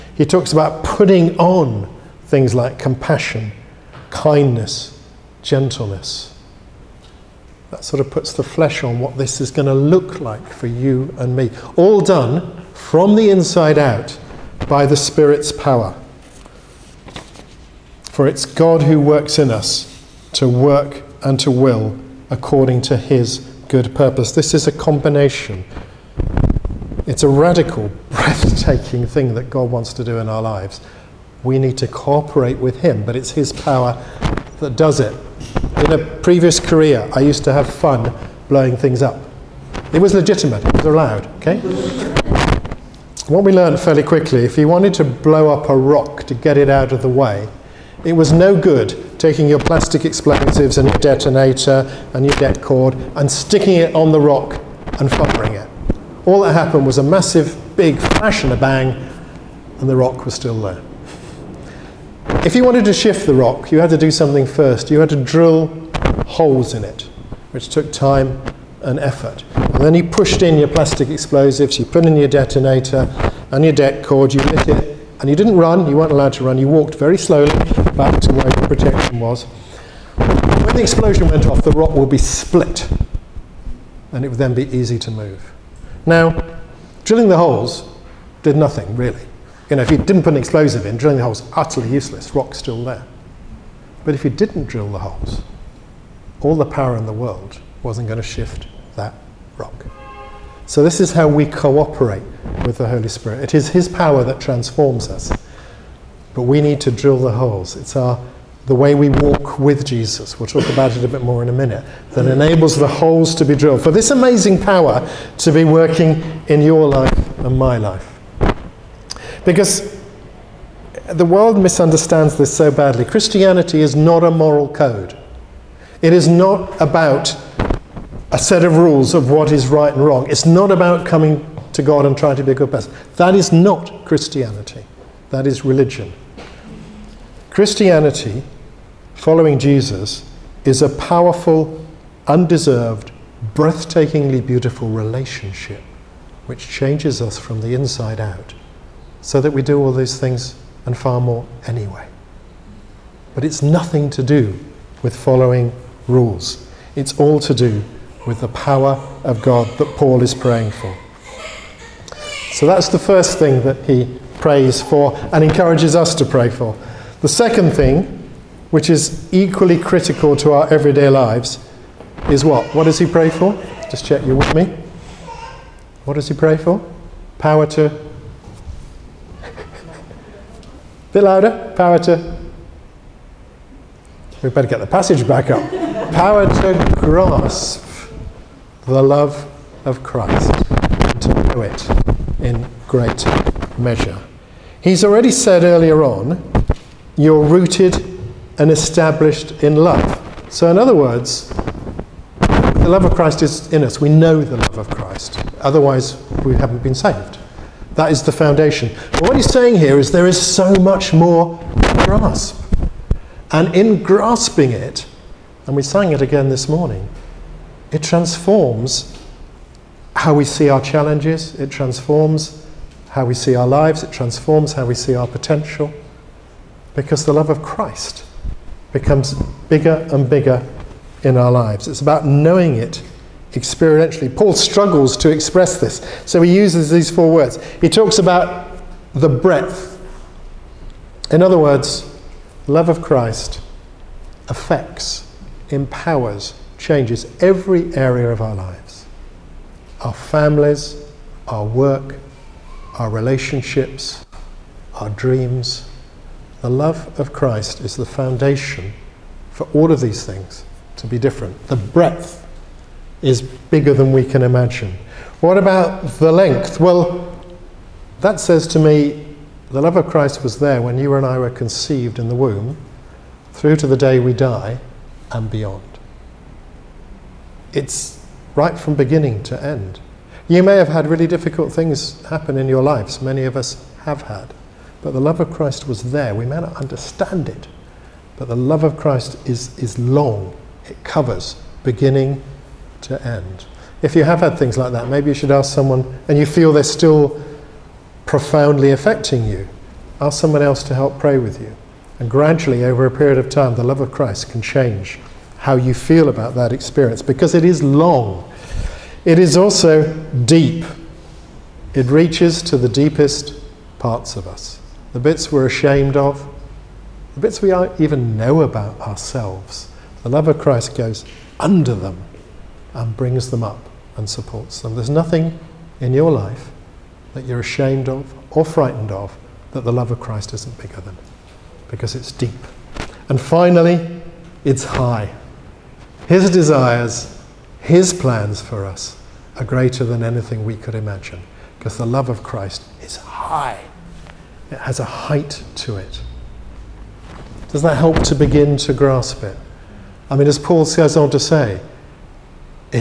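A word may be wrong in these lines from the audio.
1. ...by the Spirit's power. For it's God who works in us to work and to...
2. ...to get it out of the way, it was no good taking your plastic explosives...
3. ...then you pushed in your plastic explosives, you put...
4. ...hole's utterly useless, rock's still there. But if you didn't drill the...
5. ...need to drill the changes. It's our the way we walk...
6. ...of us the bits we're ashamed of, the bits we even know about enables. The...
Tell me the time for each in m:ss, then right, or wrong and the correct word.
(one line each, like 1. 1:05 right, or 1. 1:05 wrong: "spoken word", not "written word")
1. 0:14 right
2. 0:46 right
3. 1:09 right
4. 1:31 right
5. 1:46 wrong: "holes", not "changes"
6. 5:14 wrong: "ourselves", not "enables".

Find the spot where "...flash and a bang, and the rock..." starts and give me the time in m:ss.
0:57.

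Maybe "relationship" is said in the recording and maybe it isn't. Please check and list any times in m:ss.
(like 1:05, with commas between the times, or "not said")
2:24, 4:13.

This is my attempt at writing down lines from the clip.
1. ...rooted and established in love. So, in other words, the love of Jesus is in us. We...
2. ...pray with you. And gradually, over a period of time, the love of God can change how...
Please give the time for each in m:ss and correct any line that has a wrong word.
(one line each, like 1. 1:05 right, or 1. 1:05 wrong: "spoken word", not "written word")
1. 3:17 wrong: "Christ", not "Jesus"
2. 5:01 wrong: "Christ", not "God".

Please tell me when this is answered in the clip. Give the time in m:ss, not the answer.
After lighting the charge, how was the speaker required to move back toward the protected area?
1:16.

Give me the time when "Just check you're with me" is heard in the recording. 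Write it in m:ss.
2:53.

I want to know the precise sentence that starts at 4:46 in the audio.
We may not understand it, but the love of Christ is, is long, it covers beginning to end.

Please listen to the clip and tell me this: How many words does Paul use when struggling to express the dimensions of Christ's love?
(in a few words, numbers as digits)
4.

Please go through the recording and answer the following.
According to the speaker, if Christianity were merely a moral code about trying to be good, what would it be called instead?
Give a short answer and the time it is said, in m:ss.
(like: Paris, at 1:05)
religion, at 2:15.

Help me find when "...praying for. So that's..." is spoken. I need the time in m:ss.
2:40.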